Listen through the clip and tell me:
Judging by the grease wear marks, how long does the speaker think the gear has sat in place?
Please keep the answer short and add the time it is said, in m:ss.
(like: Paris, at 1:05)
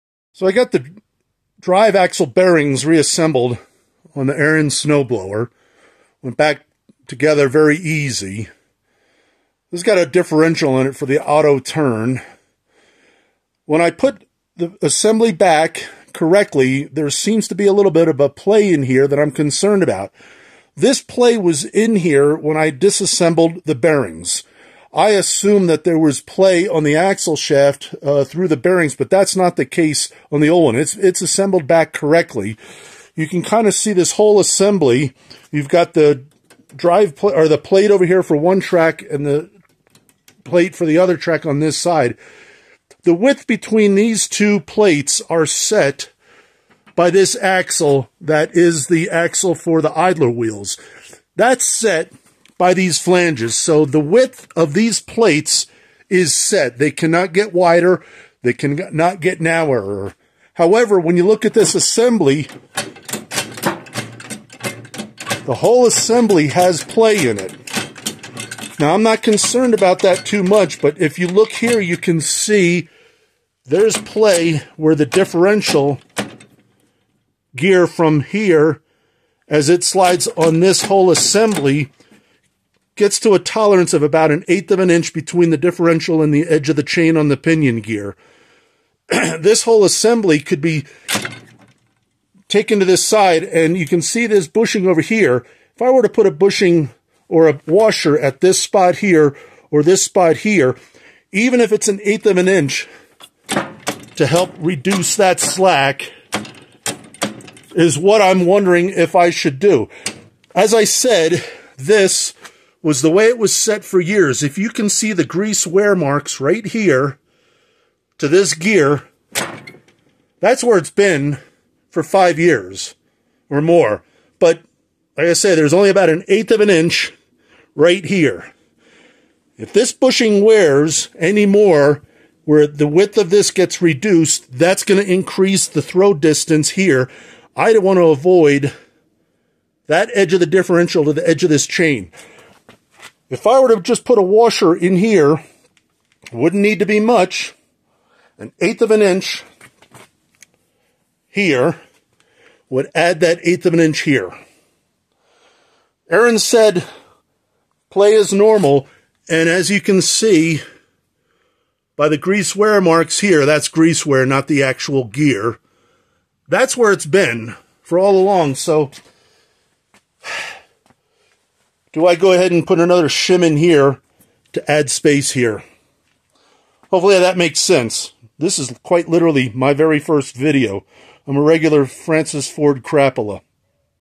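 5 years or more, at 2:02.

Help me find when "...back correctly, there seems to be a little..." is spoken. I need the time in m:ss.
0:15.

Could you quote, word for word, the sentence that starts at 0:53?
So the width of these plates is set.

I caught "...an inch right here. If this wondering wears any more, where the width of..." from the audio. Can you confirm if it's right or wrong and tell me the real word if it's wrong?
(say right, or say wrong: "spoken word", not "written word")
wrong: "bushing", not "wondering".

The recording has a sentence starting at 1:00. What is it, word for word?
However, when you look at this assembly, the whole assembly has play in it.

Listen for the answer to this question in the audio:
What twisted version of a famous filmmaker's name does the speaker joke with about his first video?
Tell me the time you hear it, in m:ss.
3:01.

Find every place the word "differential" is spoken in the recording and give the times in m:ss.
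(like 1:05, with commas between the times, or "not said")
0:10, 1:15, 1:25, 2:20.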